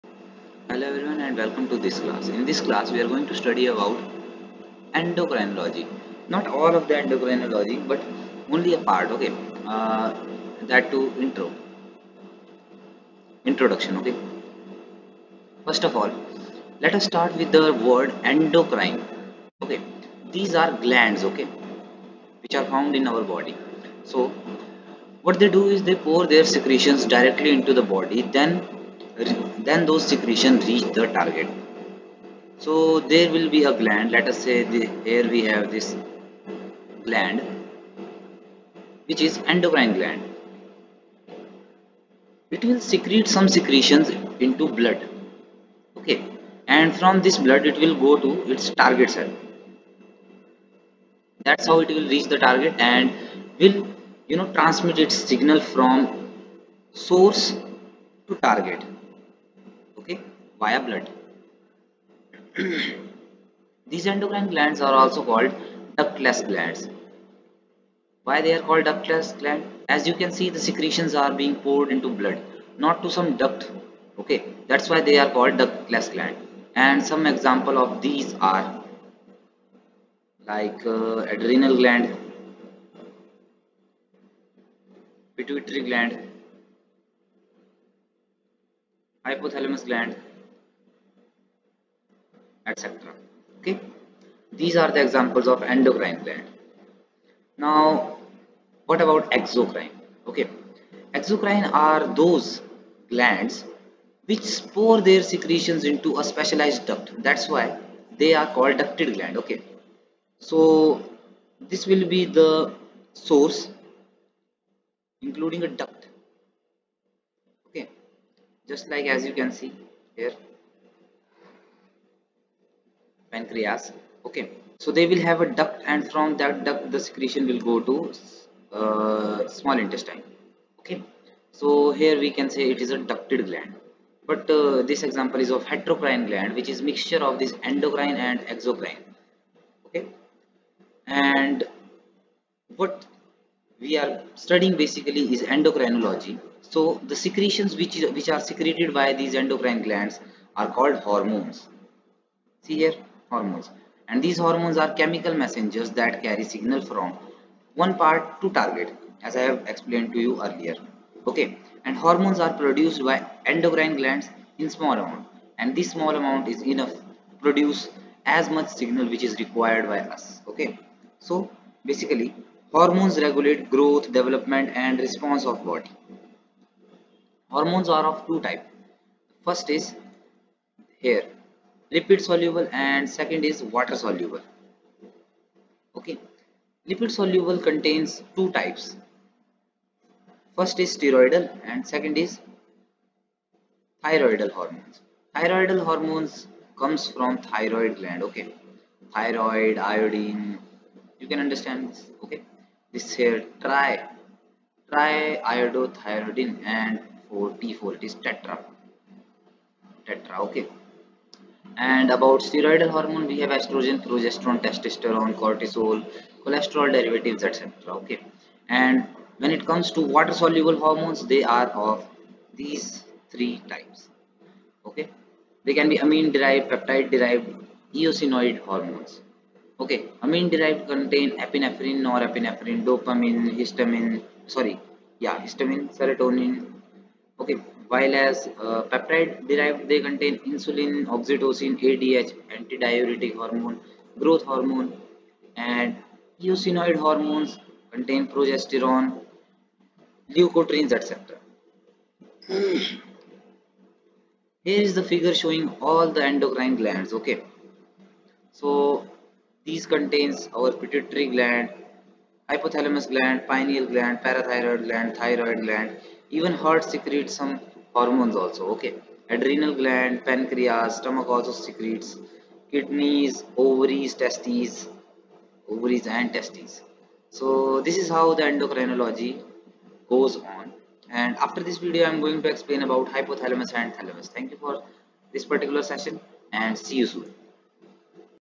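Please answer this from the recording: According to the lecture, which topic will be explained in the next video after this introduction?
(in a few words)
Hypothalamus and thalamus.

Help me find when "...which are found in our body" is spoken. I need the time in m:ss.
0:22.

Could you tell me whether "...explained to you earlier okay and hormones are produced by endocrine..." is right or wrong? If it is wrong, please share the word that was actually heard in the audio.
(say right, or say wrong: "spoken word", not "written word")
right.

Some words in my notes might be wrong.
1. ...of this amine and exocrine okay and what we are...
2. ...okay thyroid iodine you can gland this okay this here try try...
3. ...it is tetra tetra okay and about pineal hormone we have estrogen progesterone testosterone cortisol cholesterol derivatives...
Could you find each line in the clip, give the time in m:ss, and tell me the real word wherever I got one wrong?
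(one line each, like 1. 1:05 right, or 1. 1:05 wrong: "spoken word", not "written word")
1. 2:17 wrong: "endocrine", not "amine"
2. 3:18 wrong: "understand", not "gland"
3. 3:27 wrong: "steroidal", not "pineal".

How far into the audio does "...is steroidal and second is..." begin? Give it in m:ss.
3:10.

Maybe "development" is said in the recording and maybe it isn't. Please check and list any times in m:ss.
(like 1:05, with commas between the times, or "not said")
2:54.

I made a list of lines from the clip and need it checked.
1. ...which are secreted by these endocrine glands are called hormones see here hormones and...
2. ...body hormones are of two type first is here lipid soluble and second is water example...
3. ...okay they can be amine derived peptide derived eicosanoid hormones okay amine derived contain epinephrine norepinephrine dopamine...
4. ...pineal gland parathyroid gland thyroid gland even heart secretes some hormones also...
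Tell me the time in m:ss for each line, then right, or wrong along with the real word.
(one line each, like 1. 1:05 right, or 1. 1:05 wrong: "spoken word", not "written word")
1. 2:28 right
2. 2:55 wrong: "soluble", not "example"
3. 3:44 right
4. 4:23 right.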